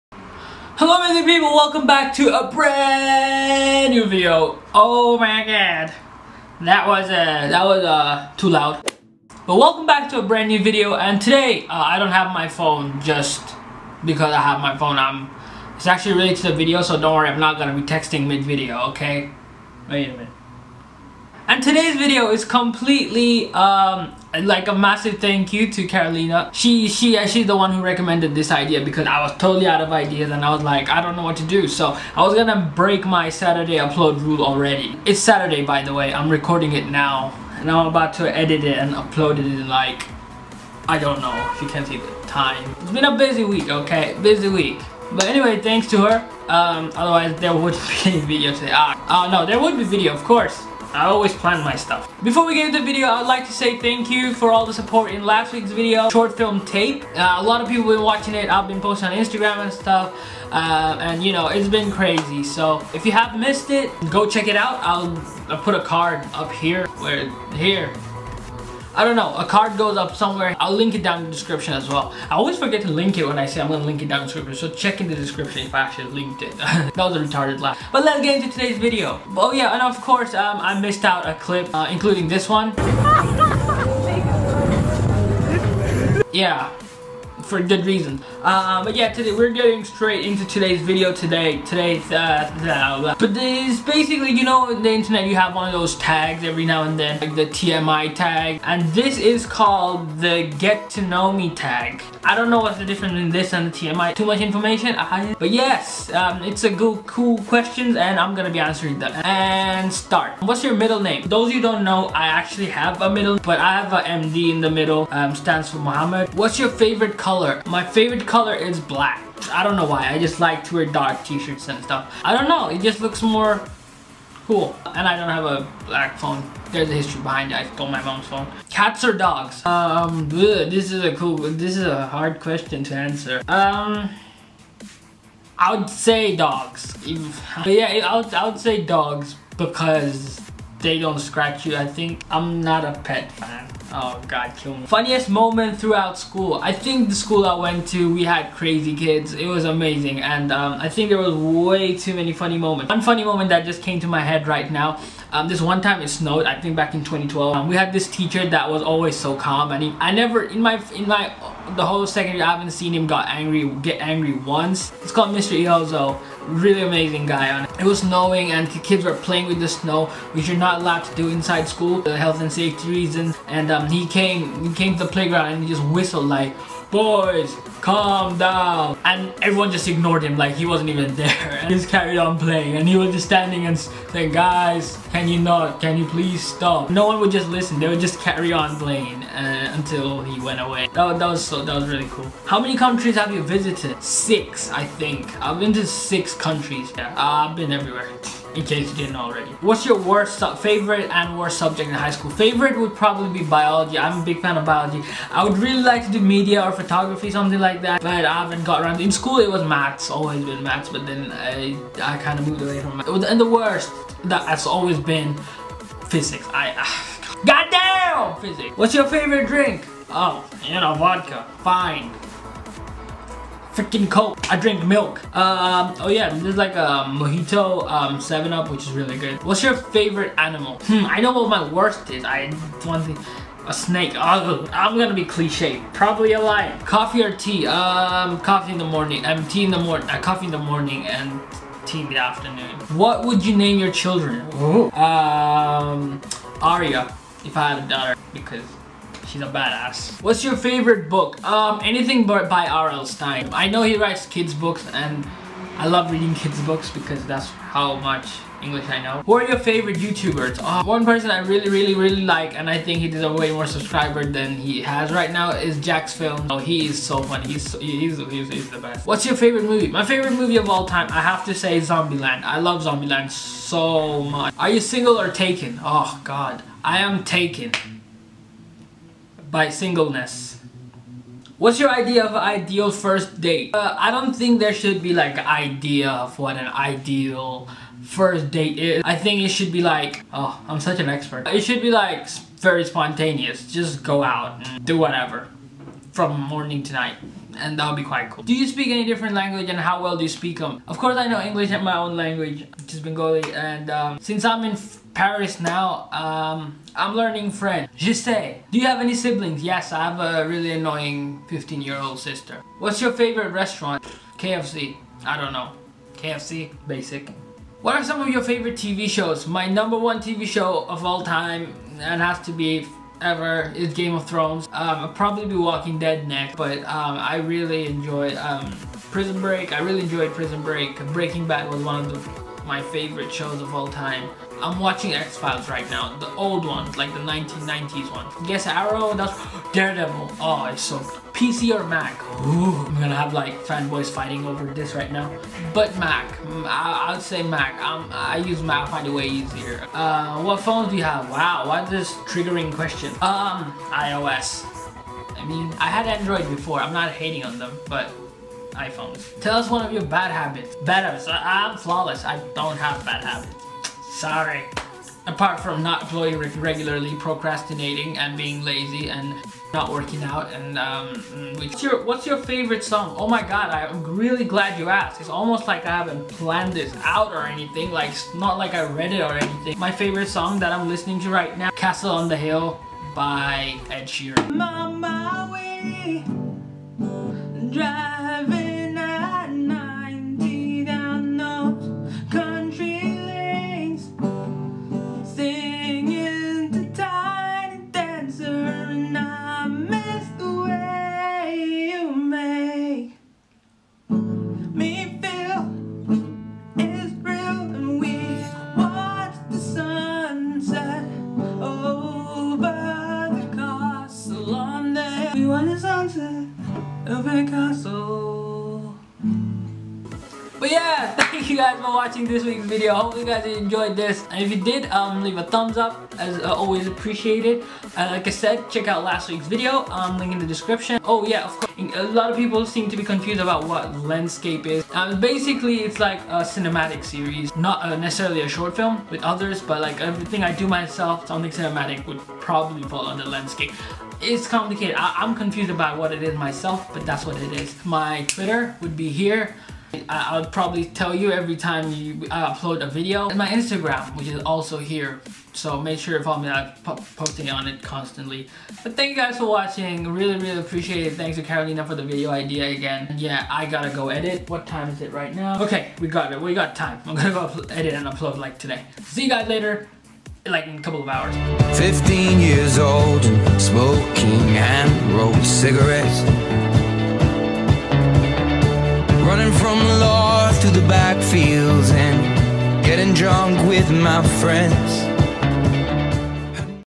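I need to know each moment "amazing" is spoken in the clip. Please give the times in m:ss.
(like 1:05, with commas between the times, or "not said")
0:00, 2:29, 2:46.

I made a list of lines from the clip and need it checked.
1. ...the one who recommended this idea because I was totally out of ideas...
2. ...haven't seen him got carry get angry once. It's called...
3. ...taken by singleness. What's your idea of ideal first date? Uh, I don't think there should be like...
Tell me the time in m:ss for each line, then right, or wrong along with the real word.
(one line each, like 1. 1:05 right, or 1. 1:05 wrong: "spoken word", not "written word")
1. 0:27 right
2. 2:42 wrong: "angry", not "carry"
3. 4:37 right.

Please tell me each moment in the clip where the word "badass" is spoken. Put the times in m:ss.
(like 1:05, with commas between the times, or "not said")
4:09.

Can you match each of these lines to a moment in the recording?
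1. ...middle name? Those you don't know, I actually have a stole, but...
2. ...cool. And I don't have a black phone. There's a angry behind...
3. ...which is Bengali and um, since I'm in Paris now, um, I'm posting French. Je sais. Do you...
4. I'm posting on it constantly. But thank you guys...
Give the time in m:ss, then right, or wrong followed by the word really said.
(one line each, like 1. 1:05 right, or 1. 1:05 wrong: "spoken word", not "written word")
1. 1:50 wrong: "middle", not "stole"
2. 2:04 wrong: "history", not "angry"
3. 5:02 wrong: "learning", not "posting"
4. 7:36 right.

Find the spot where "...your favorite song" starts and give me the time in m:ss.
6:12.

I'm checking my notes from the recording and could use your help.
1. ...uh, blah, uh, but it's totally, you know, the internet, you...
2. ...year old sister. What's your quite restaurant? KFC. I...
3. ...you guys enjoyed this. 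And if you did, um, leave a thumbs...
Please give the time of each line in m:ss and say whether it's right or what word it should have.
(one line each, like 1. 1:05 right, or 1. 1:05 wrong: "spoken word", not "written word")
1. 1:32 wrong: "basically", not "totally"
2. 5:11 wrong: "favorite", not "quite"
3. 7:03 right.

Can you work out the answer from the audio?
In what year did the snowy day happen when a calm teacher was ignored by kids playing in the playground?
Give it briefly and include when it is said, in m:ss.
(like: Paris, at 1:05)
2012, at 2:37.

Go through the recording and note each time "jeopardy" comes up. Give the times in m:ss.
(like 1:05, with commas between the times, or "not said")
not said.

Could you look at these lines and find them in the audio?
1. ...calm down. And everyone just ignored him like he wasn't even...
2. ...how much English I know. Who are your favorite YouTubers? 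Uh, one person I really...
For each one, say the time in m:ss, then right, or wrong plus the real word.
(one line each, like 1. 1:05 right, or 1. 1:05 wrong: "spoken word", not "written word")
1. 2:57 right
2. 4:17 right.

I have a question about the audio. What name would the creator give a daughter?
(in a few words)
Aria.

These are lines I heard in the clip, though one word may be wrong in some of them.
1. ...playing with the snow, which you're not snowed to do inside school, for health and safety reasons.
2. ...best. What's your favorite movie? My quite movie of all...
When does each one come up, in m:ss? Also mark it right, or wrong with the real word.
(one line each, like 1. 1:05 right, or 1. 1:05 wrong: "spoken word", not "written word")
1. 2:49 wrong: "allowed", not "snowed"
2. 4:28 wrong: "favorite", not "quite".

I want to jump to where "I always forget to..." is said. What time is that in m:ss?
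1:12.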